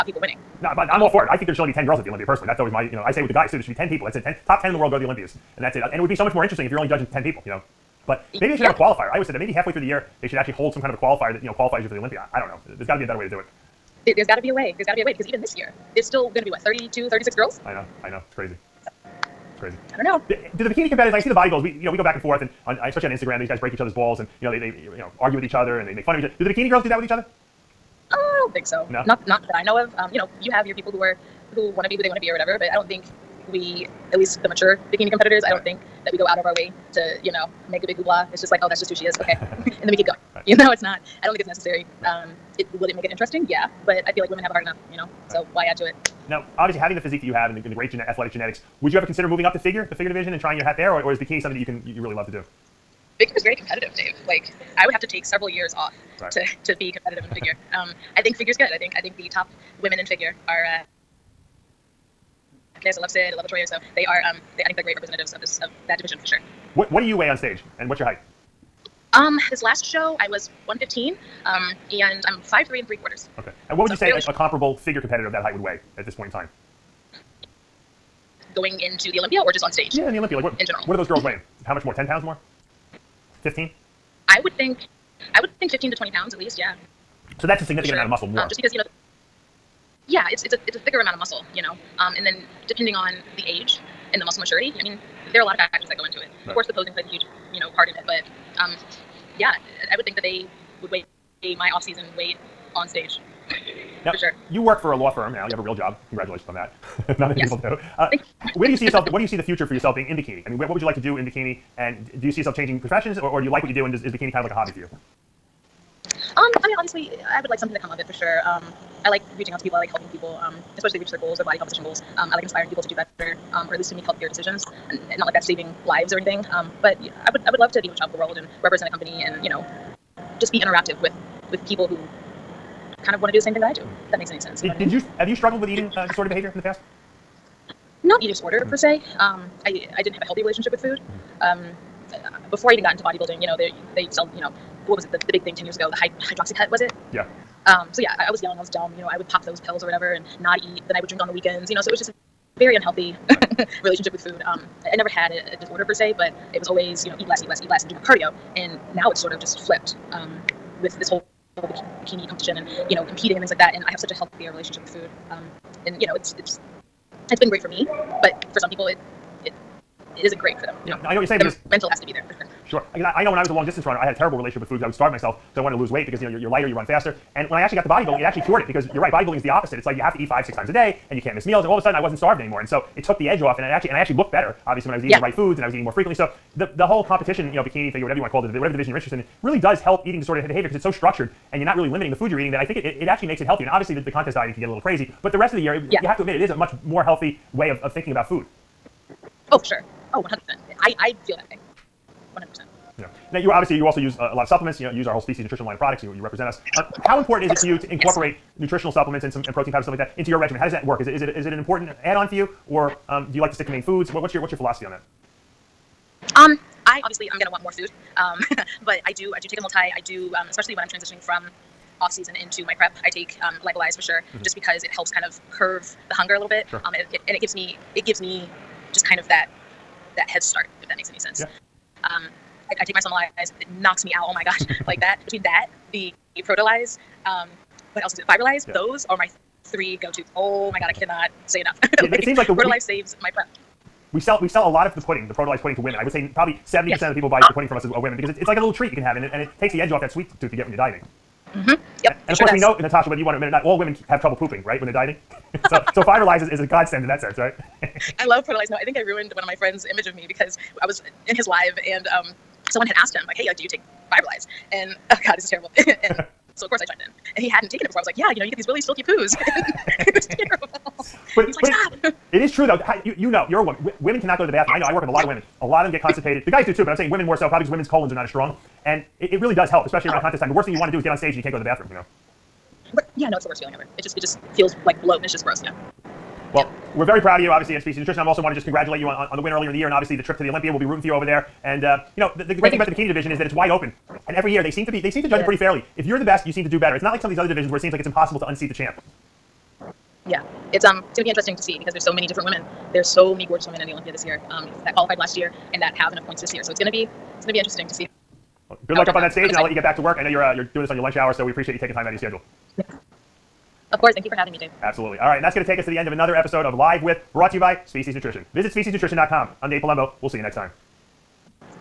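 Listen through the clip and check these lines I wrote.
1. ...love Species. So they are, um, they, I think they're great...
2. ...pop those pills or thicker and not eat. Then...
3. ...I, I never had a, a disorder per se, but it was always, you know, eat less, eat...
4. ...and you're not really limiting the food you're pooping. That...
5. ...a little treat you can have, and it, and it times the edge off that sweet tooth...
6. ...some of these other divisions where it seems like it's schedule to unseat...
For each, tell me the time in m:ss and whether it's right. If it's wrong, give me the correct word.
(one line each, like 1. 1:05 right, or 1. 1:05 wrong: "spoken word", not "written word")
1. 1:03 wrong: "Latoya", not "Species"
2. 2:29 wrong: "whatever", not "thicker"
3. 2:34 right
4. 3:11 wrong: "eating", not "pooping"
5. 4:08 wrong: "takes", not "times"
6. 4:57 wrong: "impossible", not "schedule".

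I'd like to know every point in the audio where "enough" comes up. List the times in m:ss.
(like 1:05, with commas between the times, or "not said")
0:44, 4:01, 5:06.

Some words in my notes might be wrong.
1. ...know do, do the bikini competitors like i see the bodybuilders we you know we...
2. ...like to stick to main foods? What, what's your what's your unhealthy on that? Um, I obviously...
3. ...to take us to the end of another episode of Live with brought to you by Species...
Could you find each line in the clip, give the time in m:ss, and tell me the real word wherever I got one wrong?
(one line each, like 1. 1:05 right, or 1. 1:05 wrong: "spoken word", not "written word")
1. 0:20 right
2. 3:33 wrong: "philosophy", not "unhealthy"
3. 5:15 right.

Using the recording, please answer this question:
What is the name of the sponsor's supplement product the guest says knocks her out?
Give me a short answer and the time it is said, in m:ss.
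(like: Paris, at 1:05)
Somalyze, at 3:52.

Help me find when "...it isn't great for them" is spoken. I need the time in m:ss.
2:50.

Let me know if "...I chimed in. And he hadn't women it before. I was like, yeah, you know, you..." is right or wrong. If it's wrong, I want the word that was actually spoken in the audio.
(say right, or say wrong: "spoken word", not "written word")
wrong: "taken", not "women".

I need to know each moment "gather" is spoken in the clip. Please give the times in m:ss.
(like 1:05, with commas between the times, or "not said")
not said.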